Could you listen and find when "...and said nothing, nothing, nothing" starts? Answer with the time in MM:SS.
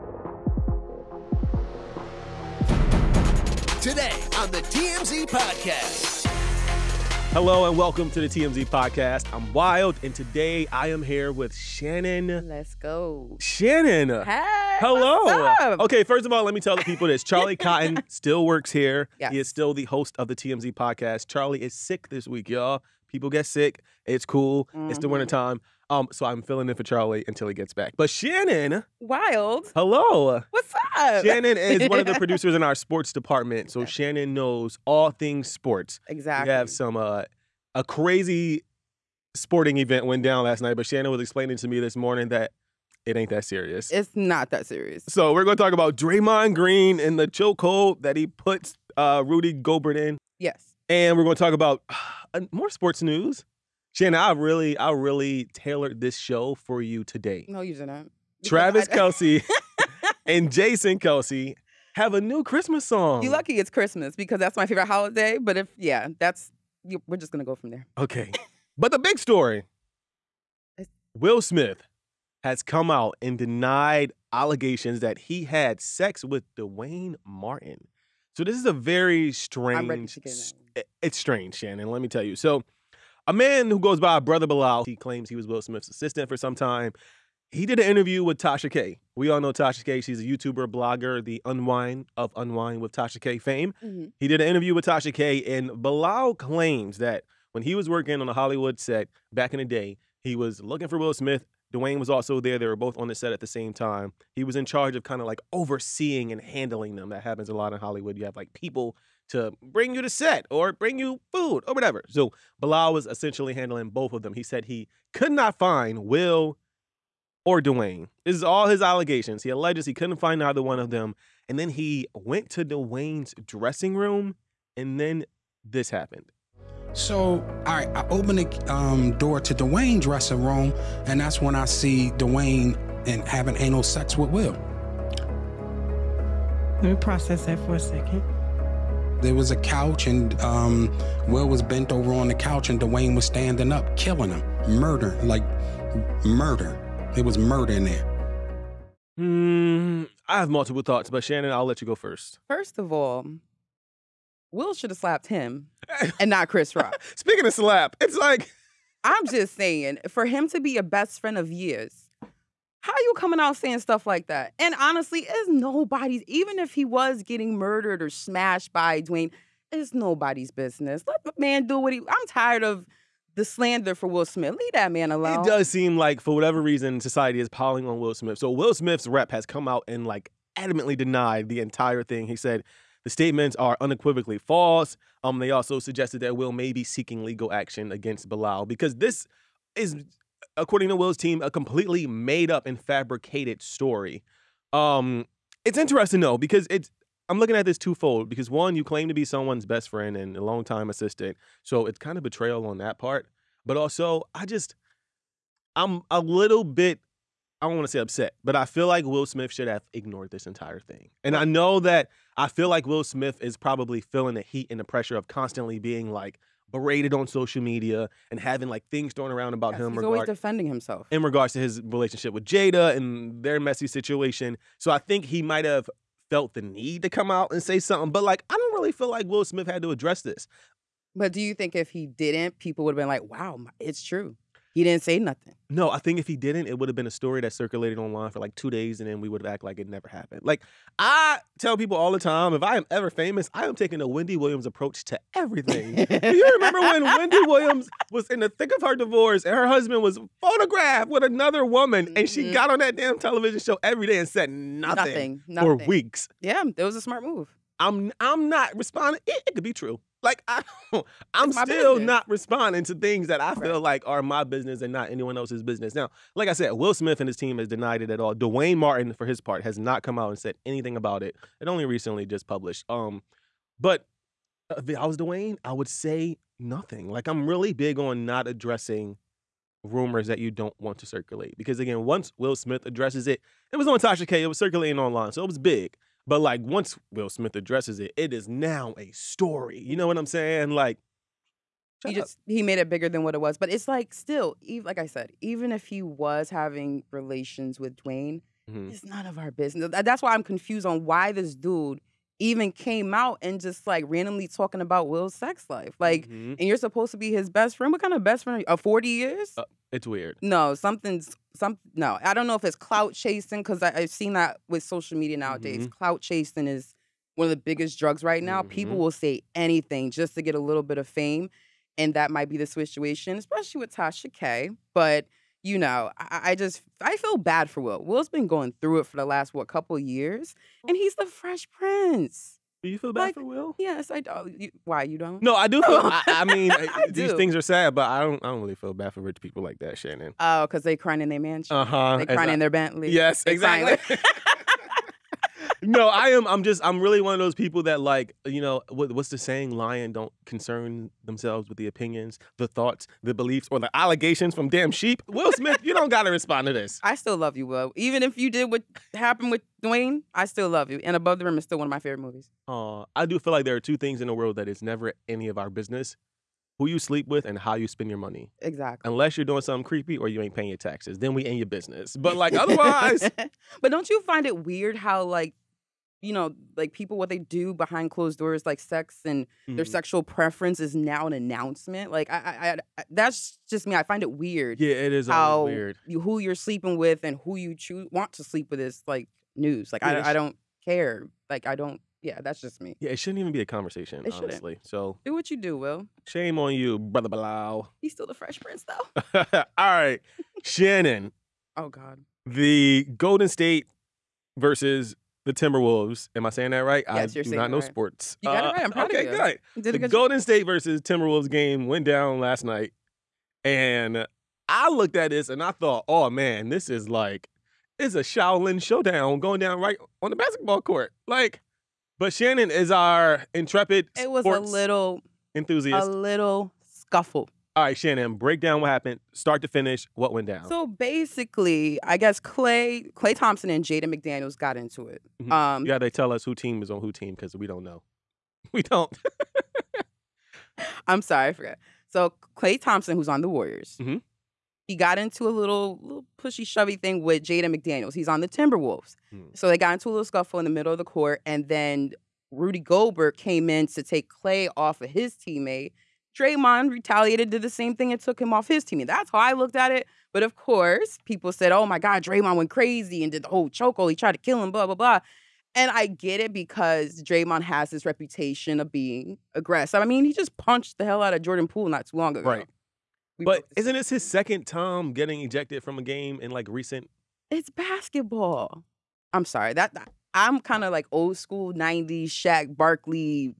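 04:14.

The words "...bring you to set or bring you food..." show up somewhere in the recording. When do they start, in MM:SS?
01:49.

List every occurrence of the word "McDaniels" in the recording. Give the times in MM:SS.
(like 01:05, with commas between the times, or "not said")
07:14, 07:27.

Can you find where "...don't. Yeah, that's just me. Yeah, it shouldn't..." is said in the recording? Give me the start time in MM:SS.
06:31.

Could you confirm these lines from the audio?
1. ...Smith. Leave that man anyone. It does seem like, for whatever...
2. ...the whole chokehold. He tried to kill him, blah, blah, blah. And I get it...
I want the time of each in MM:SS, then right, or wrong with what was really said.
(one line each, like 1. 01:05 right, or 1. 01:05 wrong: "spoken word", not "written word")
1. 02:54 wrong: "alone", not "anyone"
2. 07:43 right.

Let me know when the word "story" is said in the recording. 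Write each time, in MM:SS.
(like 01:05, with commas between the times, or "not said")
01:09, 03:13, 03:57, 04:49.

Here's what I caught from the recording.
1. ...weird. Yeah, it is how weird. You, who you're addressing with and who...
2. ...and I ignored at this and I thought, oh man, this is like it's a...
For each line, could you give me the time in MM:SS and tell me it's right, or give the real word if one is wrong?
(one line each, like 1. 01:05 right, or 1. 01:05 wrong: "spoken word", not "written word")
1. 06:24 wrong: "sleeping", not "addressing"
2. 06:53 wrong: "looked", not "ignored".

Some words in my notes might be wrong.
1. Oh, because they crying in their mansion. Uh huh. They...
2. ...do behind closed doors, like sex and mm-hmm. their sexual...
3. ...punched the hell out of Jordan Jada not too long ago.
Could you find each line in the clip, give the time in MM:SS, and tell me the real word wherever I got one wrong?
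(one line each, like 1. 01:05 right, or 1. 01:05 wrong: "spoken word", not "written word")
1. 05:40 right
2. 06:17 right
3. 07:50 wrong: "Poole", not "Jada".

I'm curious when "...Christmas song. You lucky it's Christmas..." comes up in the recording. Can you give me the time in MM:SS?
01:02.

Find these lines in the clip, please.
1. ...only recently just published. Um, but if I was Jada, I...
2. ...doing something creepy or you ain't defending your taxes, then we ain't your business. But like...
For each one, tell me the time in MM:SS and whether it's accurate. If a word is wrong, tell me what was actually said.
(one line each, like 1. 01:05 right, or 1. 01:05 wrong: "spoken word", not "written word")
1. 04:31 wrong: "Duane", not "Jada"
2. 06:09 wrong: "paying", not "defending".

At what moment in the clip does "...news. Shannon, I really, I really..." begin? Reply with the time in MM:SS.
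00:53.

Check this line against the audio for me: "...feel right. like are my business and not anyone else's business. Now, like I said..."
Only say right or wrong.
right.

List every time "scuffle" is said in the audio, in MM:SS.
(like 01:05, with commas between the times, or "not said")
07:06, 07:30.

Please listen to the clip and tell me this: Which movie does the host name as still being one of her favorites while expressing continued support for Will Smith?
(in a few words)
Above the Rim.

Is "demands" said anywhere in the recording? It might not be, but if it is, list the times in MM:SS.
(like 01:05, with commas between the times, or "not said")
not said.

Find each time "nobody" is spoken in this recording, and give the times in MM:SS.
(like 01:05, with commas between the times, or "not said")
02:45, 02:49.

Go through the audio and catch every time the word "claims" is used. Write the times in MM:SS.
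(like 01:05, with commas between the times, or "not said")
01:24, 01:36, 03:18.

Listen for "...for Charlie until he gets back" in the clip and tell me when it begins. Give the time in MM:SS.
00:26.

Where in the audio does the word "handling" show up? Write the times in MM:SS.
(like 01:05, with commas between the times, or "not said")
01:46, 01:53.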